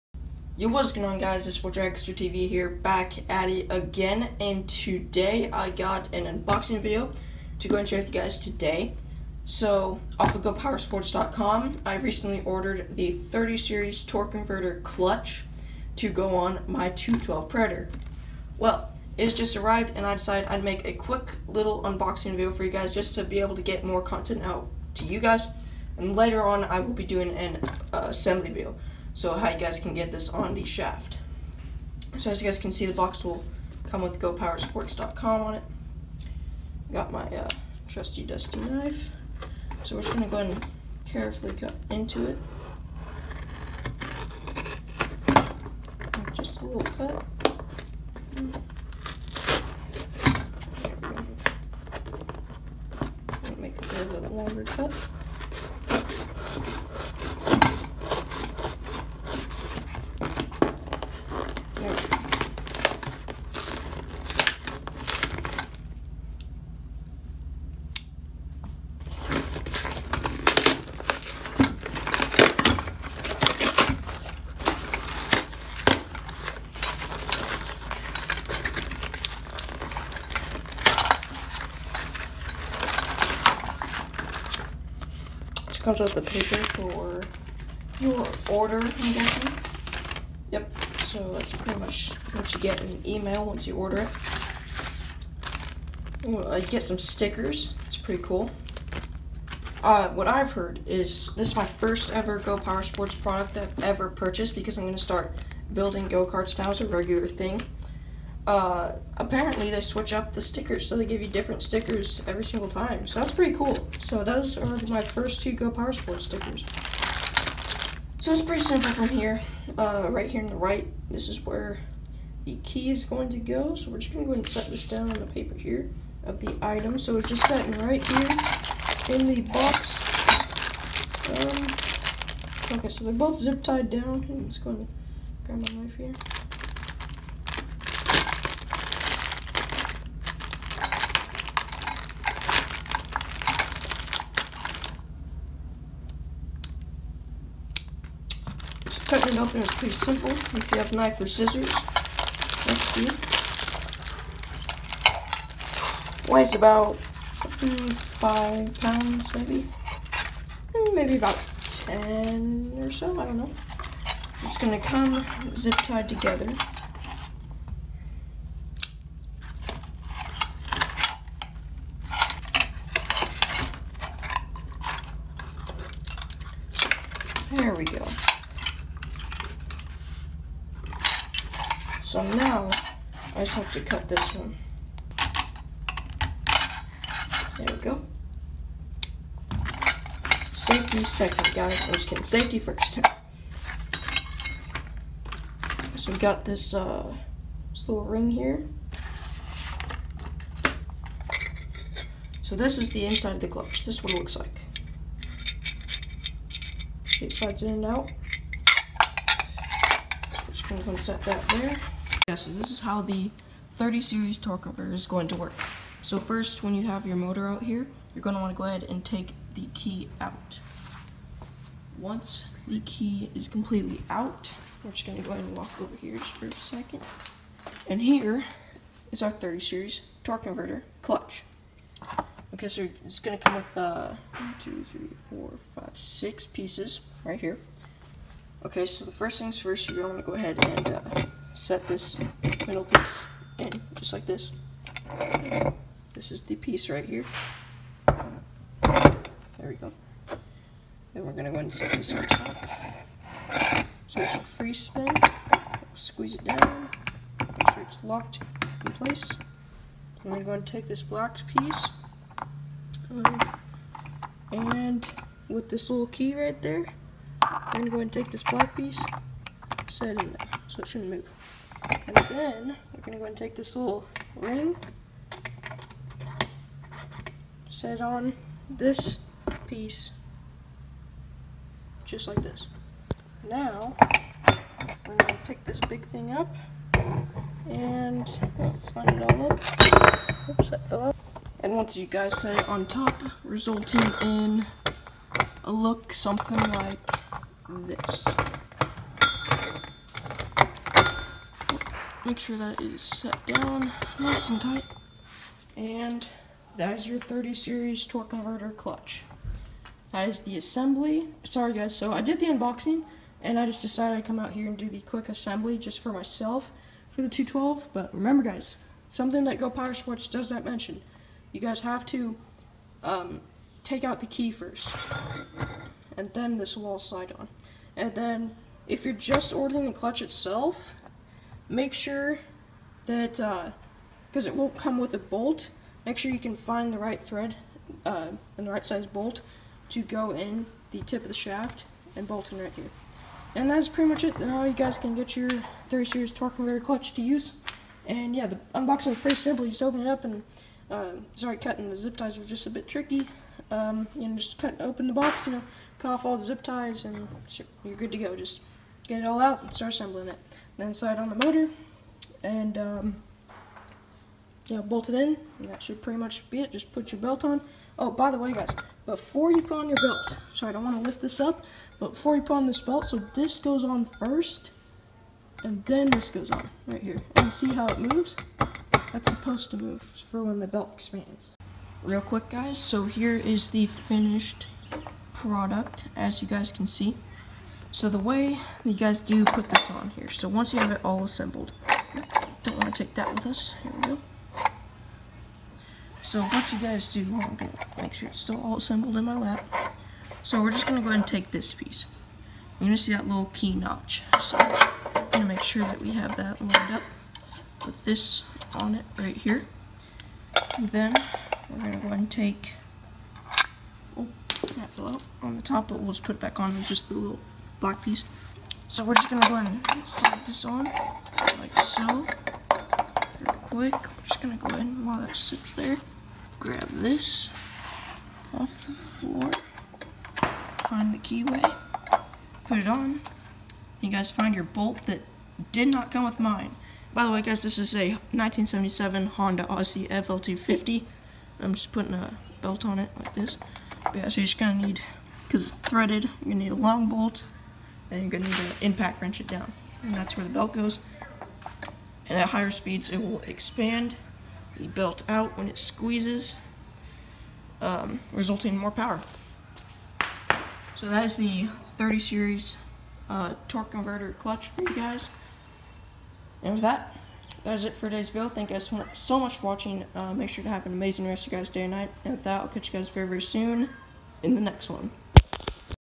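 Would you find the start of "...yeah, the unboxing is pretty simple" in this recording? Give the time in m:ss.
5:48.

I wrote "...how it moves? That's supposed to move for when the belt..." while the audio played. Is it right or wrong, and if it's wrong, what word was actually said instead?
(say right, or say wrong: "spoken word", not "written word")
right.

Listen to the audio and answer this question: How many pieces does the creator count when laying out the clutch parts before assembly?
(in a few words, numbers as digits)
6.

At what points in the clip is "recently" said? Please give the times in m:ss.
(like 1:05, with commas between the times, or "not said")
0:11.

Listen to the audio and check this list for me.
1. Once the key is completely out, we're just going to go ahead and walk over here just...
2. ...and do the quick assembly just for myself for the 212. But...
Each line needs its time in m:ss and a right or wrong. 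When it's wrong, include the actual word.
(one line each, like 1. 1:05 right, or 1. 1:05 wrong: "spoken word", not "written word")
1. 3:41 right
2. 5:14 right.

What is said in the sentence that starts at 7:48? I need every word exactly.
Thank you guys so much for watching.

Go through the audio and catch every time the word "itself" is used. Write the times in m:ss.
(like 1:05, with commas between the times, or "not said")
5:30.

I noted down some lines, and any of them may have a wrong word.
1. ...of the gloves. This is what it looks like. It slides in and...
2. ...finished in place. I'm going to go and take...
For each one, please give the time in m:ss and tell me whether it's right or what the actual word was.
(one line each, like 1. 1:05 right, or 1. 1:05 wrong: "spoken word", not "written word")
1. 3:23 right
2. 4:18 wrong: "locked", not "finished".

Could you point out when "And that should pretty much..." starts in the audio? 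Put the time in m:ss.
6:05.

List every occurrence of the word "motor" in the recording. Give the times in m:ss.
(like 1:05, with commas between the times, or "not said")
3:37, 6:01.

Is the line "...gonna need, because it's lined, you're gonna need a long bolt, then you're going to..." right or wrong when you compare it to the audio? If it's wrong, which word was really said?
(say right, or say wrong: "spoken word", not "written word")
wrong: "threaded", not "lined".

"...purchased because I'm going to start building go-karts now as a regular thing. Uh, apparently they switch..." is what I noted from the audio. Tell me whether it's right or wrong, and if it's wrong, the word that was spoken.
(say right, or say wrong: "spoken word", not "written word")
right.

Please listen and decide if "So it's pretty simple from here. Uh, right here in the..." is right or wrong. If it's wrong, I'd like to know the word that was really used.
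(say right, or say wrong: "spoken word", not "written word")
right.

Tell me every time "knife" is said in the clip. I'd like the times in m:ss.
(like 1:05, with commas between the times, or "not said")
0:38, 2:15, 2:30.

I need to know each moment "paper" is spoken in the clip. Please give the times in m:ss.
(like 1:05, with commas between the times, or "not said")
1:26, 2:05.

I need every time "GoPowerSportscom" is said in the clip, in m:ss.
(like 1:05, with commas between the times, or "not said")
0:10, 0:34.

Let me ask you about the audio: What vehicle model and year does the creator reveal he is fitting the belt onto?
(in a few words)
1977 Honda Odyssey FL250.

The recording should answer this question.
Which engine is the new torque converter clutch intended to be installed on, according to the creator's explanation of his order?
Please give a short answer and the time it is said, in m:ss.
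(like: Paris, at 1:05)
212 Predator, at 0:16.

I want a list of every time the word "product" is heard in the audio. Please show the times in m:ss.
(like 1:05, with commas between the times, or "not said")
1:43, 6:25.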